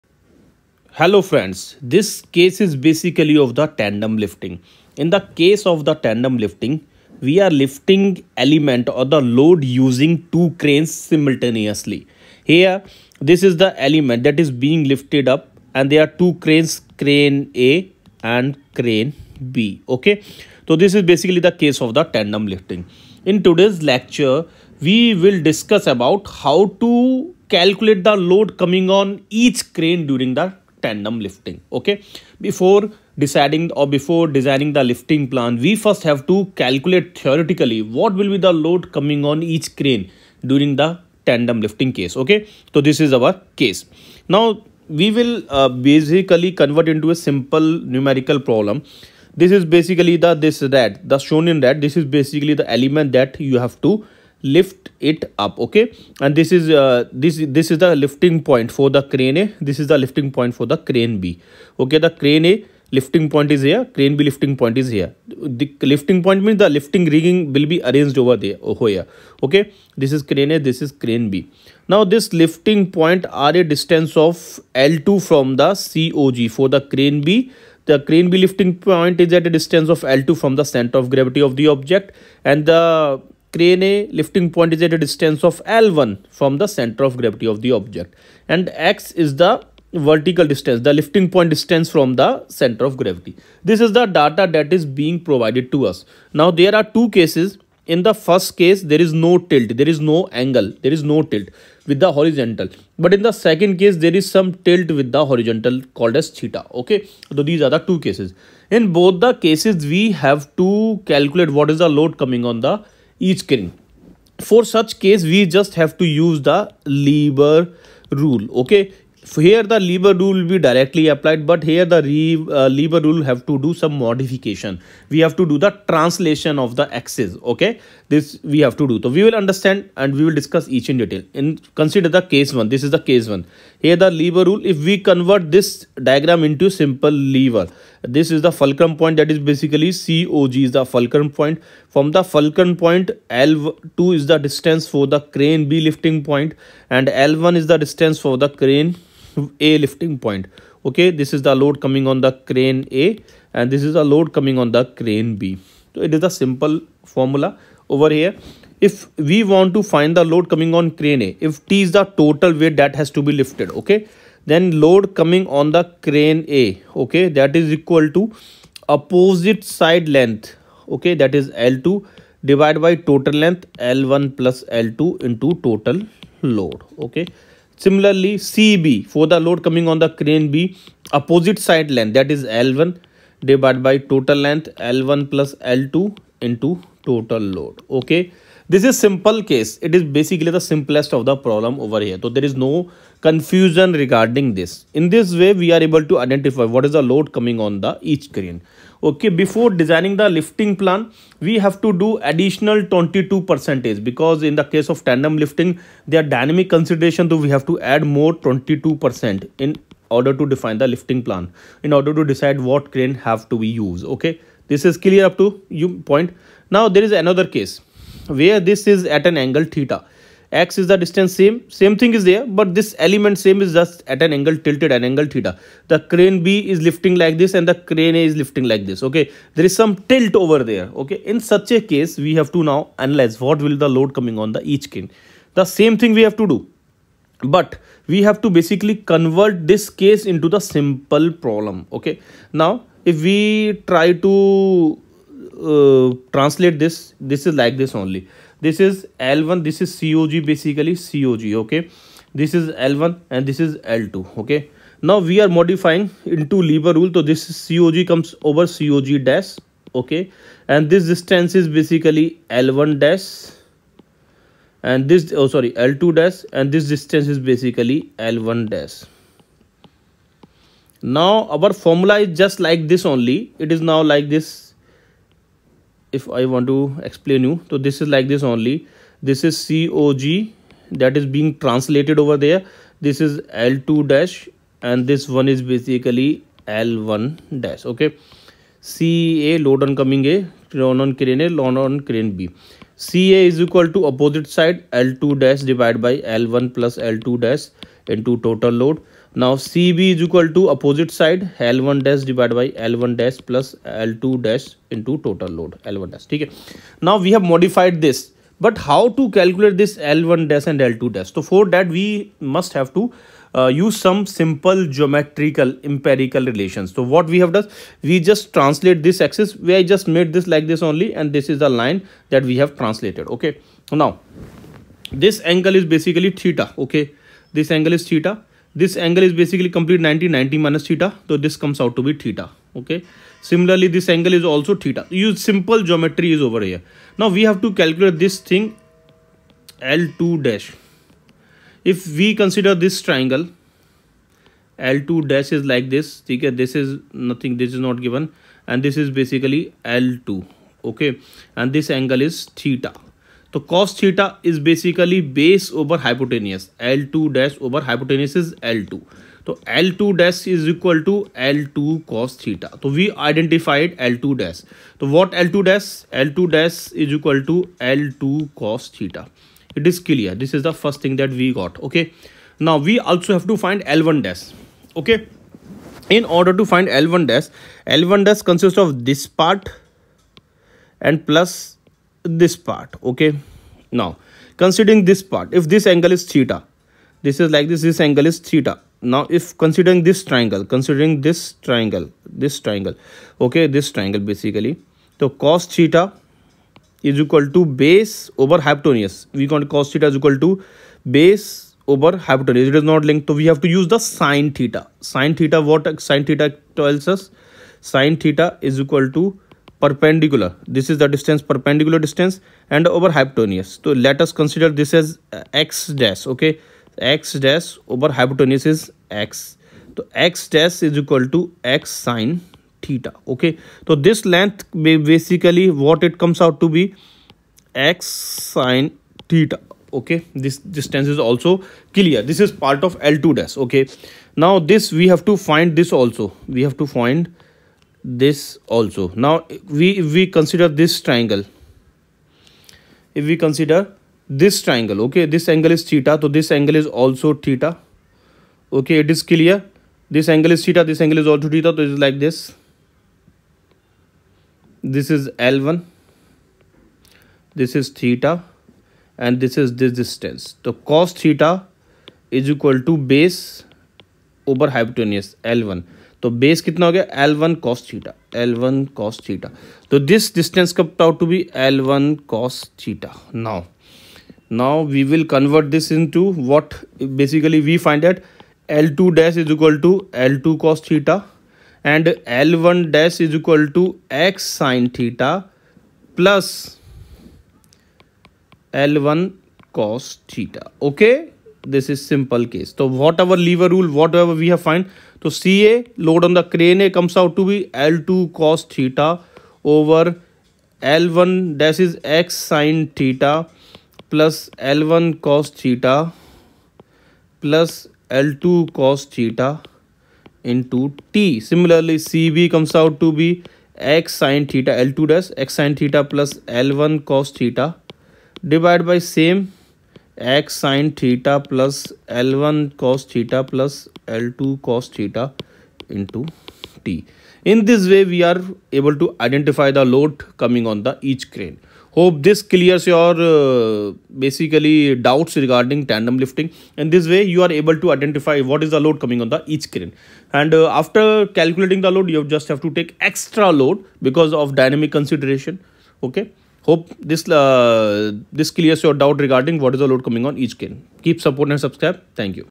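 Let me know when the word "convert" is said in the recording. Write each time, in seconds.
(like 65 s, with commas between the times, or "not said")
46 s, 135 s, 239 s.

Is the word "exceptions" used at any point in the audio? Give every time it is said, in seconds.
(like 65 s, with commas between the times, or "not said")
not said.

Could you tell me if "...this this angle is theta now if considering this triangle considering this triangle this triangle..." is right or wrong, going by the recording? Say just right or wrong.
right.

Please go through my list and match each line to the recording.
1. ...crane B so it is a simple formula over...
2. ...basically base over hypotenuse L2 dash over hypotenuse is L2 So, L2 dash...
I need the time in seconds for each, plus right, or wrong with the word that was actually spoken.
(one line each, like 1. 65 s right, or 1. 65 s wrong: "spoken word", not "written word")
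1. 154 s right
2. 354 s right.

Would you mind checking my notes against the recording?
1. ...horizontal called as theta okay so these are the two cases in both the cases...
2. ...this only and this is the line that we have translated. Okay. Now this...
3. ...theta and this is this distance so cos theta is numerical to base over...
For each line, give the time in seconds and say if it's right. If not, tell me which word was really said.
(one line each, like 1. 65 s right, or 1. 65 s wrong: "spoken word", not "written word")
1. 105 s right
2. 320 s right
3. 457 s wrong: "equal", not "numerical".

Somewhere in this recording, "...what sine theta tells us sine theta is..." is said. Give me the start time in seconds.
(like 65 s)
405 s.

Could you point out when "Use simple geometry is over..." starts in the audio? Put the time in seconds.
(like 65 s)
335 s.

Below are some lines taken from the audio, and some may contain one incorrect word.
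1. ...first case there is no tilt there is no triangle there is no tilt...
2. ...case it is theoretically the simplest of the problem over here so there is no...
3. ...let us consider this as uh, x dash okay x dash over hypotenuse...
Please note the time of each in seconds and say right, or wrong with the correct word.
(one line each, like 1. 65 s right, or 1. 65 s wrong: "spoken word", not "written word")
1. 98 s wrong: "angle", not "triangle"
2. 189 s wrong: "basically", not "theoretically"
3. 414 s right.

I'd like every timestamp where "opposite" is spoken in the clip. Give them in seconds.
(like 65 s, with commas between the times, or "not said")
168 s, 181 s, 294 s, 300 s.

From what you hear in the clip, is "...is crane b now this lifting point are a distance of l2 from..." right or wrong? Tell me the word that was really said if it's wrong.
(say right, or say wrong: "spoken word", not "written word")
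right.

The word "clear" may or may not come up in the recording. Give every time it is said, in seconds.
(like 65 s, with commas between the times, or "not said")
215 s, 370 s, 431 s, 449 s, 532 s, 548 s.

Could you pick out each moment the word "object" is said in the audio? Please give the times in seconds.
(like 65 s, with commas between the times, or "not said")
81 s, 87 s.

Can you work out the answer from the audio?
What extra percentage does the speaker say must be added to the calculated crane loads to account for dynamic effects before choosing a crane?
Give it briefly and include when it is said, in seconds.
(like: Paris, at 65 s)
22 percent, at 208 s.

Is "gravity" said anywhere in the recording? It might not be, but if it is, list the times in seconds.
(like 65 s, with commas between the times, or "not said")
81 s, 87 s, 92 s.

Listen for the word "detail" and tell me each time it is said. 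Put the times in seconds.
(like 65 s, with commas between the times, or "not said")
131 s.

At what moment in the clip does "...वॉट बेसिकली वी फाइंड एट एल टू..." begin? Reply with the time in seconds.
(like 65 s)
476 s.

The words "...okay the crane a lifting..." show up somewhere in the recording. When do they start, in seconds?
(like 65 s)
61 s.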